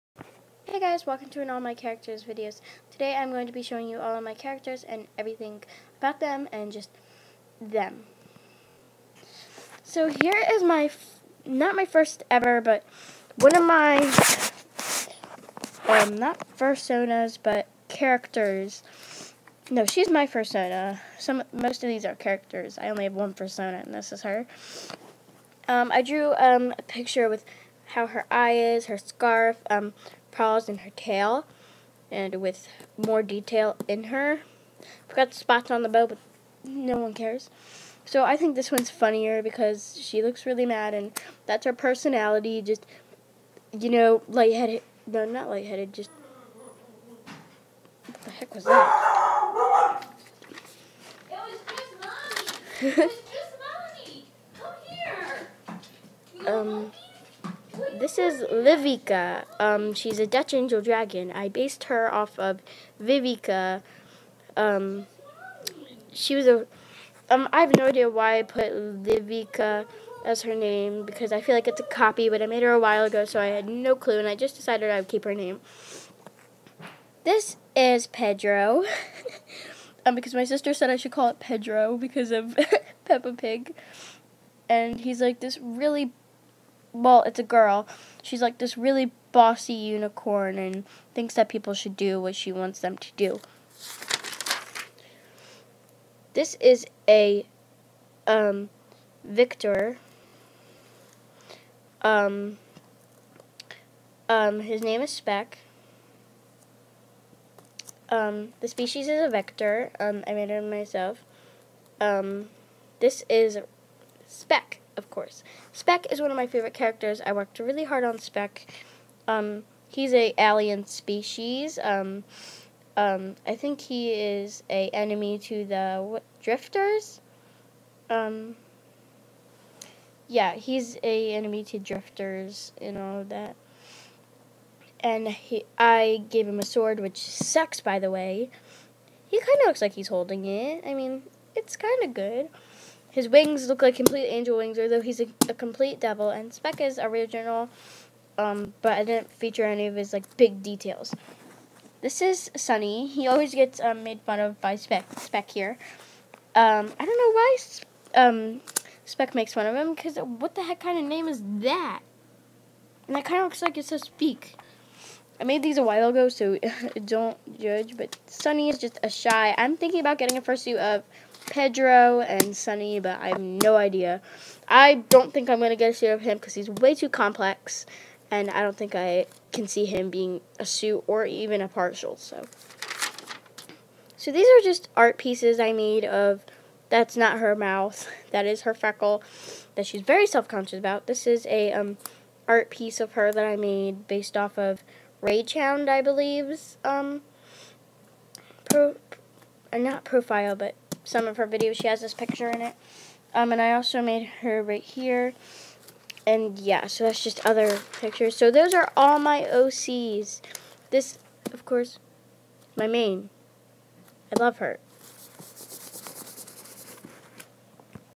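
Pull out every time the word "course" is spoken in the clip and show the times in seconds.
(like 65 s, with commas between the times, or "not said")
115 s, 211 s.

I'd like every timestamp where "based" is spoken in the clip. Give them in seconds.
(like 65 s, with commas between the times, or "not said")
61 s, 194 s.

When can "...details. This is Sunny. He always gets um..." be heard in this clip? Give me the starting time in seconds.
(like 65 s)
150 s.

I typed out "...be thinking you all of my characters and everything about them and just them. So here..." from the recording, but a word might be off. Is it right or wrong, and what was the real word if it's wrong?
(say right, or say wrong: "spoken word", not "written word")
wrong: "showing", not "thinking".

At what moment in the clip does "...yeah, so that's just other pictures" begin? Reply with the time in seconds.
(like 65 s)
206 s.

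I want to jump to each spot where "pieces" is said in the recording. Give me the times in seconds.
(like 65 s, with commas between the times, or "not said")
185 s, 192 s.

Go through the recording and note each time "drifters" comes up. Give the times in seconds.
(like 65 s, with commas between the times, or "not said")
126 s, 131 s.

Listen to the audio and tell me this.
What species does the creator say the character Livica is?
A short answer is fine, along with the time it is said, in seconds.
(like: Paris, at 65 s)
Dutch angel dragon, at 60 s.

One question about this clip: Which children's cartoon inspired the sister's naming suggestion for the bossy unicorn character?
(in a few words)
Peppa Pig.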